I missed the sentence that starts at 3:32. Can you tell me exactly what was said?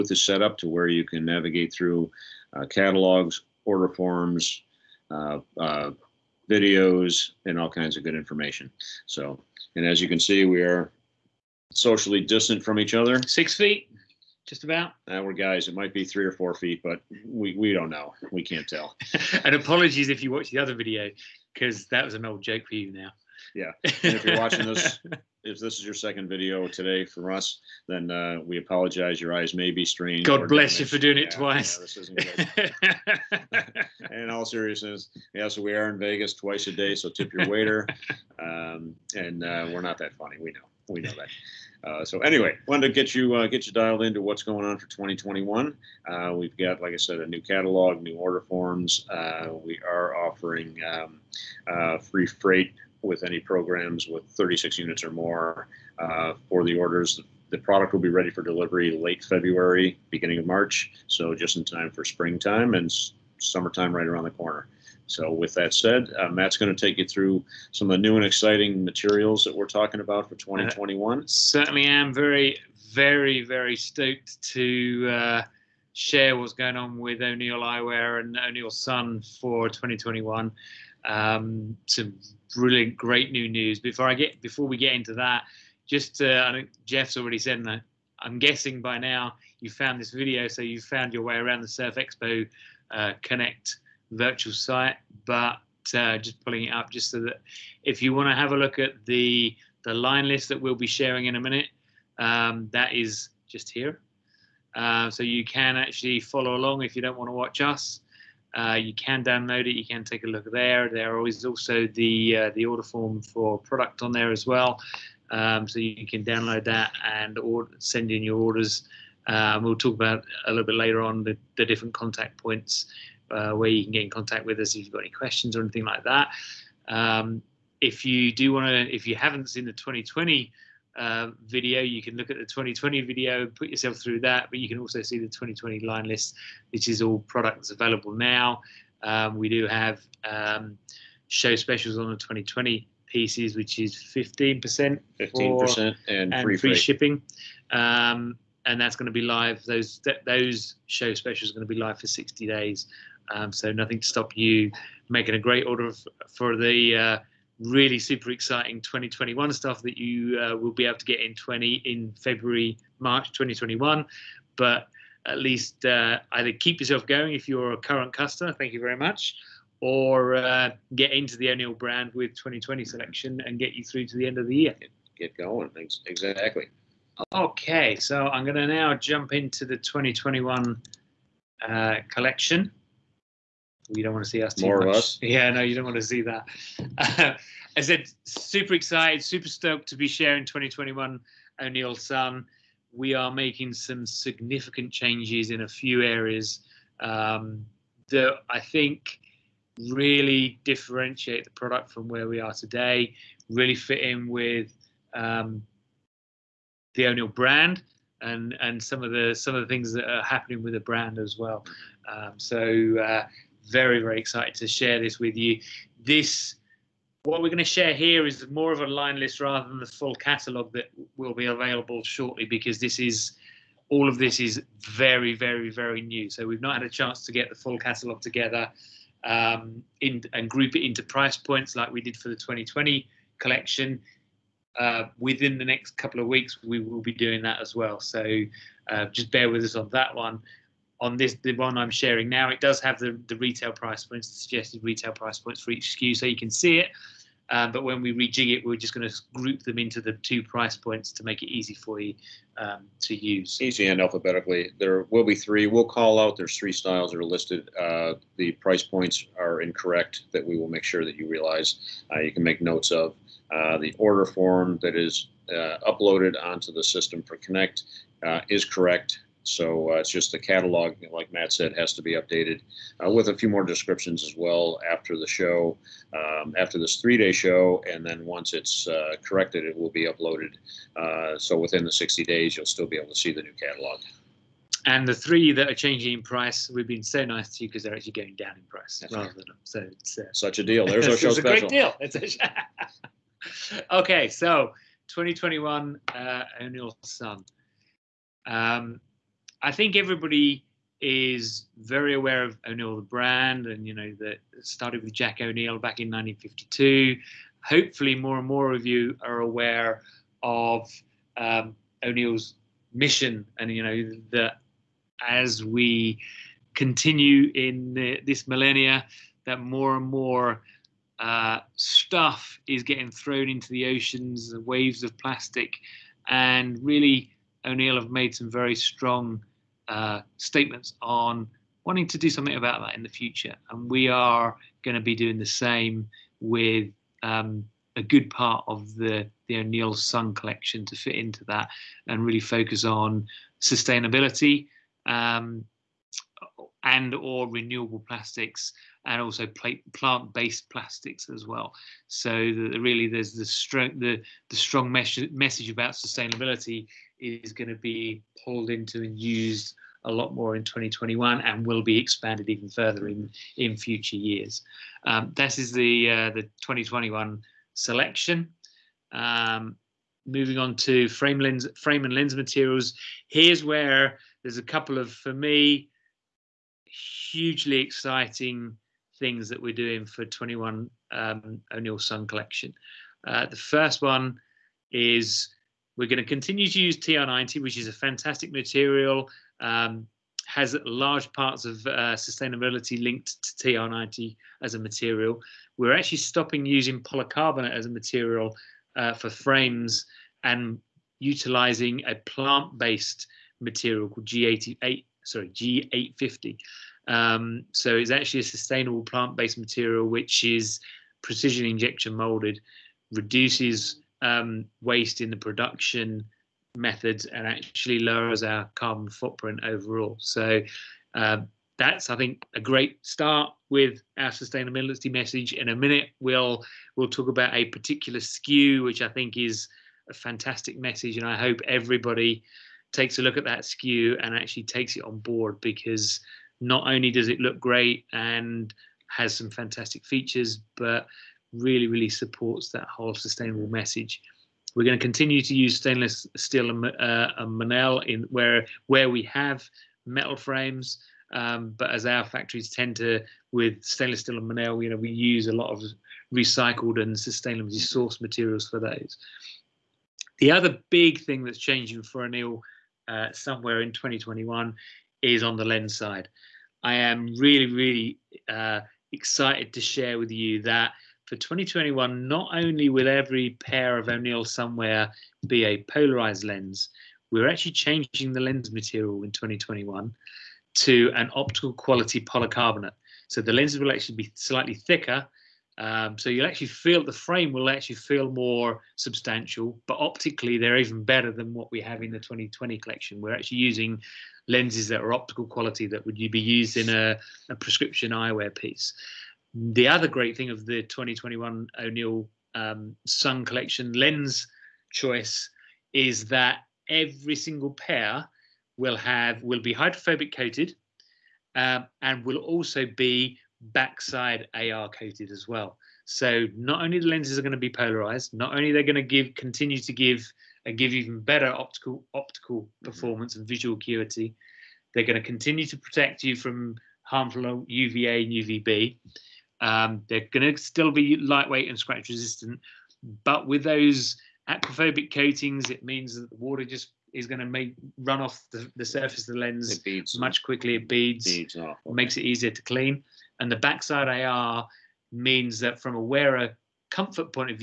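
Um, so uh, very, very excited to share this with you.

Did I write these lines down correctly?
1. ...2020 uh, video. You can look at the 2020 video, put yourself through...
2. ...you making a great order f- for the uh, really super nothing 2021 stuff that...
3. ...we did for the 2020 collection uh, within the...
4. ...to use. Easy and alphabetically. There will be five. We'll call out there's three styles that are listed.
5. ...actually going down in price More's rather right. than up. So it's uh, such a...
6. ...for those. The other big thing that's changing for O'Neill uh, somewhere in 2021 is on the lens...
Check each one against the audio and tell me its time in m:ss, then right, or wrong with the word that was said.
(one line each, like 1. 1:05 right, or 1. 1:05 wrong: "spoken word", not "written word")
1. 2:09 right
2. 2:34 wrong: "exciting", not "nothing"
3. 3:51 right
4. 4:12 wrong: "three", not "five"
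5. 4:47 wrong: "That", not "More"
6. 7:38 right.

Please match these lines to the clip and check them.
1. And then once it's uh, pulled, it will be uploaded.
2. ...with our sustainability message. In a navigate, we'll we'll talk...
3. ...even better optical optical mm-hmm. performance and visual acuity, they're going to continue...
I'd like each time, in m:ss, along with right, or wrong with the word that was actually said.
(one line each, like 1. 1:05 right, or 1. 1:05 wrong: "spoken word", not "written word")
1. 4:37 wrong: "corrected", not "pulled"
2. 7:03 wrong: "minute", not "navigate"
3. 8:40 right.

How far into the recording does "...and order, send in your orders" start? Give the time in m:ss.
1:57.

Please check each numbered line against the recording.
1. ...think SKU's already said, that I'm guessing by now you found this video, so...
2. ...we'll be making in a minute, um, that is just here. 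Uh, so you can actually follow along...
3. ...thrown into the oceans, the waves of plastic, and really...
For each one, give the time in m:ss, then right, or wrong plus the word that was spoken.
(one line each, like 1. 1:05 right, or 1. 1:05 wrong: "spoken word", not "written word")
1. 1:26 wrong: "Jeff", not "SKU"
2. 1:40 wrong: "sharing", not "making"
3. 5:23 right.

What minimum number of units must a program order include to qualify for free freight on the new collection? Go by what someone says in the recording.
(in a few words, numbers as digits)
36.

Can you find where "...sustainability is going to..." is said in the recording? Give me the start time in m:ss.
5:55.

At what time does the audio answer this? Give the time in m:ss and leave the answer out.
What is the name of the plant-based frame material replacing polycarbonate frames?
6:45.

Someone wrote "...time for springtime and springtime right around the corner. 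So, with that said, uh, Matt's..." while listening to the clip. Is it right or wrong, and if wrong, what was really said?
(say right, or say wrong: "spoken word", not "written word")
wrong: "summertime", not "springtime".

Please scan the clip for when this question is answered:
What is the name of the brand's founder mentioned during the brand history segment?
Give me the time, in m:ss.
5:05.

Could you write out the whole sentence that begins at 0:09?
So, and as you can see, we are socially distant from each other.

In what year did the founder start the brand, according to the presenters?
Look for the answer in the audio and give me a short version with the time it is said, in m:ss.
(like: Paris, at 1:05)
1952, at 5:06.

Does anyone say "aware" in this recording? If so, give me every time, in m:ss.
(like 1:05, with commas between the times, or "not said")
5:02, 5:09.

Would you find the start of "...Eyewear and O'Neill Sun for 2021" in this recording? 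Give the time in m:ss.
1:17.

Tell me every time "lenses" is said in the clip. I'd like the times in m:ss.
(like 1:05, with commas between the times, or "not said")
8:03, 8:14, 8:37.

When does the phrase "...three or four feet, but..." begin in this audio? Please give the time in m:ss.
0:16.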